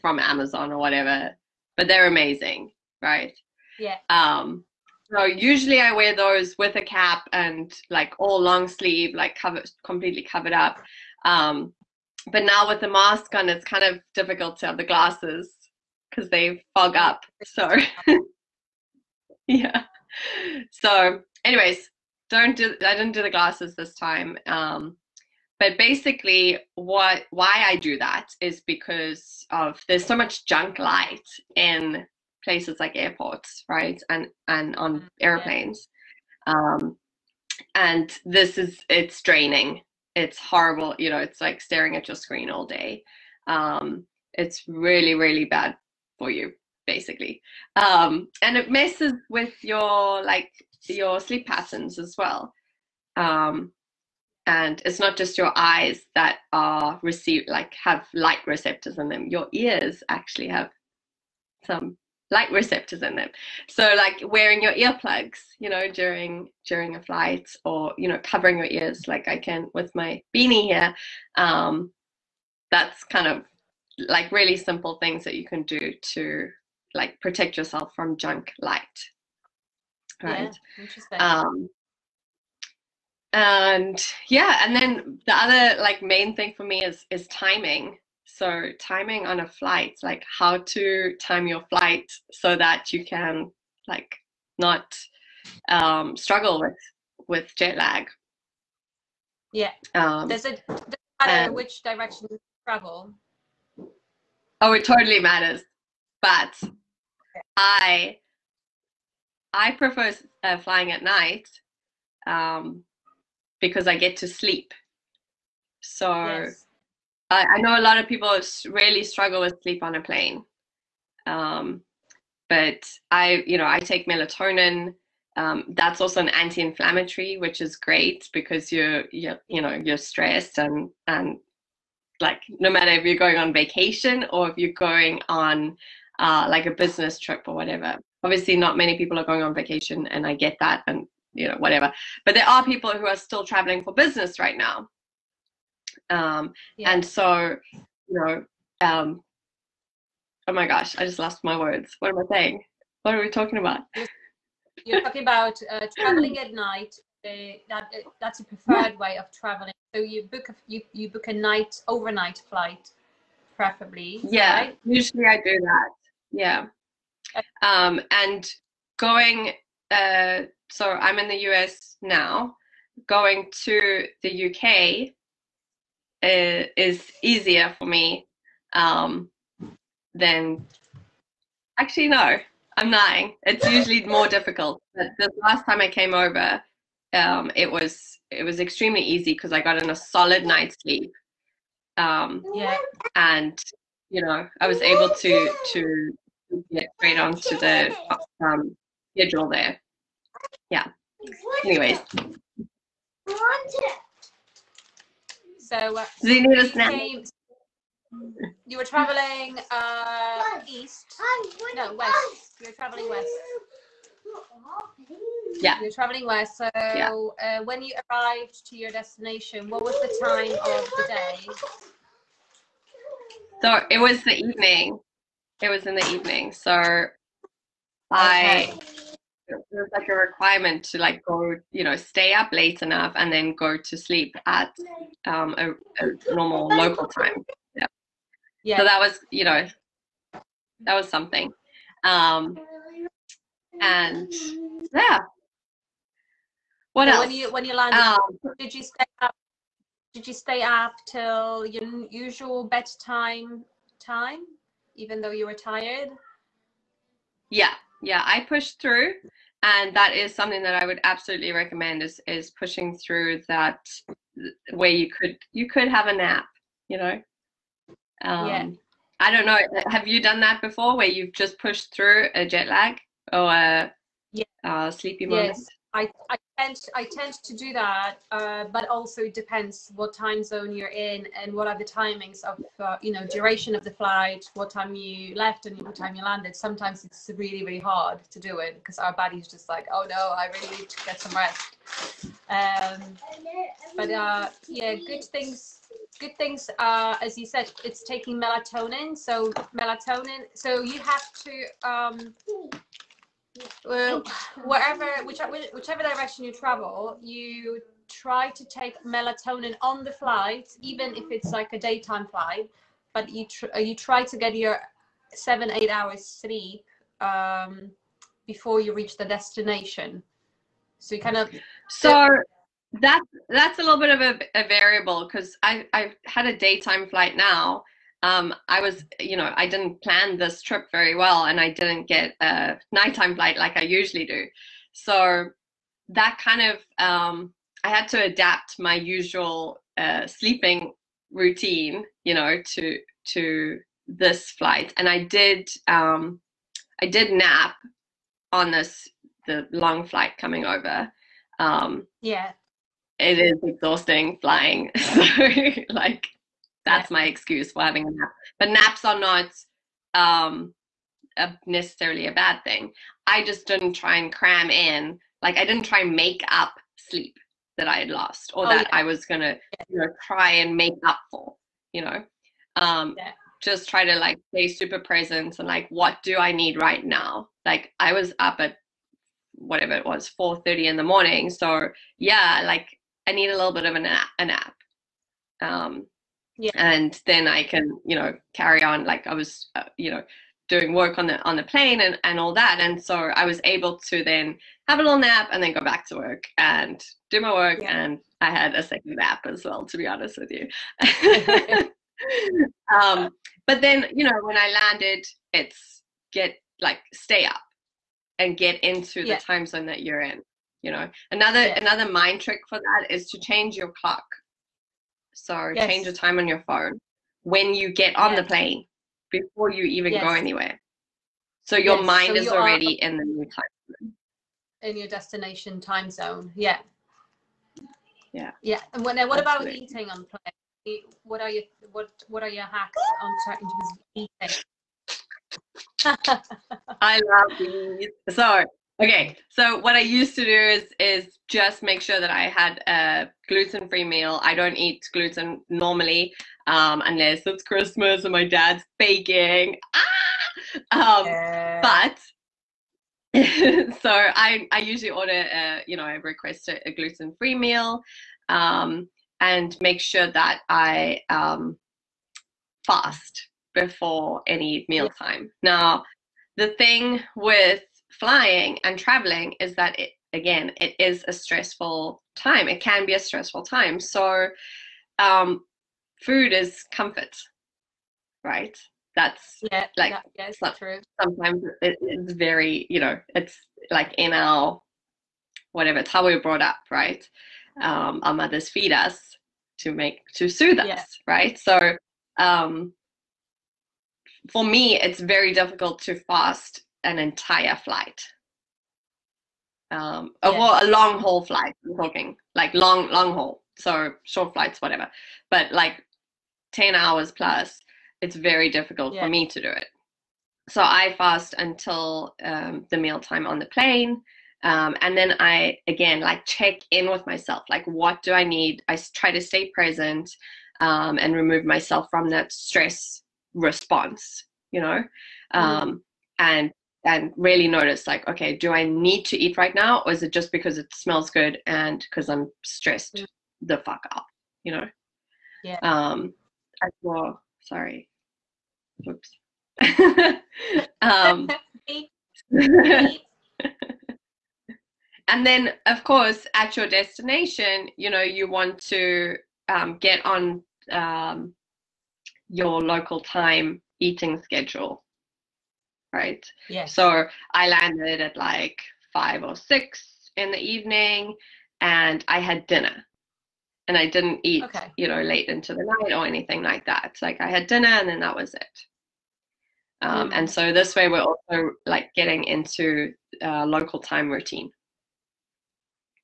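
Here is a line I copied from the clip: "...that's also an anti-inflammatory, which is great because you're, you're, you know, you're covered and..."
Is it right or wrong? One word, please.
wrong.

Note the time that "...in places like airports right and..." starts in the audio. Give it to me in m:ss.
0:31.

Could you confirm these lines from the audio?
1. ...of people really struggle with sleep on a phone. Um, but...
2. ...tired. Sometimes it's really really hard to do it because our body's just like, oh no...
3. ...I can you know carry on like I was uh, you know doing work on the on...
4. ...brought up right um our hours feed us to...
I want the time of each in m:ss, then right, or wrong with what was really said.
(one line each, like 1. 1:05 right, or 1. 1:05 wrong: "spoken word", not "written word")
1. 1:57 wrong: "plane", not "phone"
2. 4:46 wrong: "landed", not "tired"
3. 6:27 right
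4. 8:06 wrong: "mothers", not "hours".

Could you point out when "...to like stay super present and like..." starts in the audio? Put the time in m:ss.
6:14.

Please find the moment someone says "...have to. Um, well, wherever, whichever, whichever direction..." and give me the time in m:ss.
5:00.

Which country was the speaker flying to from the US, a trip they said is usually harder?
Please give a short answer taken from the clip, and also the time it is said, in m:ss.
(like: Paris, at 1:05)
The UK, at 2:54.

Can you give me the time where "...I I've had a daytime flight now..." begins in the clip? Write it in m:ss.
5:25.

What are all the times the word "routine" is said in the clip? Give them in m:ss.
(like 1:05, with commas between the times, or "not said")
5:41, 9:34.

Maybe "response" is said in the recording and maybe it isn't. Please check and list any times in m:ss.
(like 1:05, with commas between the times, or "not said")
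8:43.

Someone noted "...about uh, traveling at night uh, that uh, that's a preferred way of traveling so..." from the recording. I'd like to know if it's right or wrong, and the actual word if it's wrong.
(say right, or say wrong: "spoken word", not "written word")
right.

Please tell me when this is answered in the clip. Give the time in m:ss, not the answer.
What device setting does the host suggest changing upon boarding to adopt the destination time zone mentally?
6:55.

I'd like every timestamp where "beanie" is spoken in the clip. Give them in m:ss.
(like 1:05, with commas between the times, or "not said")
1:10.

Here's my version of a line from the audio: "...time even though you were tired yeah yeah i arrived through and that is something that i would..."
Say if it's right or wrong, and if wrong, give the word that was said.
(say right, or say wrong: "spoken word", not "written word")
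wrong: "pushed", not "arrived".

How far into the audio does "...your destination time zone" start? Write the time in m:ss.
7:04.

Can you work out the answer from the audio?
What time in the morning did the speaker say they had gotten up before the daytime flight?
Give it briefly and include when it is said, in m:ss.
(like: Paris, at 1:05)
4:30, at 6:20.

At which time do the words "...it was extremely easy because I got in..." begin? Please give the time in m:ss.
3:08.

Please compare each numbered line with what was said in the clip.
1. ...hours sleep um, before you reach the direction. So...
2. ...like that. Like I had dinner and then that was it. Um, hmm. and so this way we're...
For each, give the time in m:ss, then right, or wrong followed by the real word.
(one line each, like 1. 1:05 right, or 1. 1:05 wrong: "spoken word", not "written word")
1. 5:15 wrong: "destination", not "direction"
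2. 9:26 right.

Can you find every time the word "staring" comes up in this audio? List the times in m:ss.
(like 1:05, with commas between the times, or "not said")
0:41.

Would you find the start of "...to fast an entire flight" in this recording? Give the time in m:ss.
8:16.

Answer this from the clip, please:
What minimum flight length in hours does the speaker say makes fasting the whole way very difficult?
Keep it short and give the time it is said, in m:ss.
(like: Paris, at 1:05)
10 hours, at 8:26.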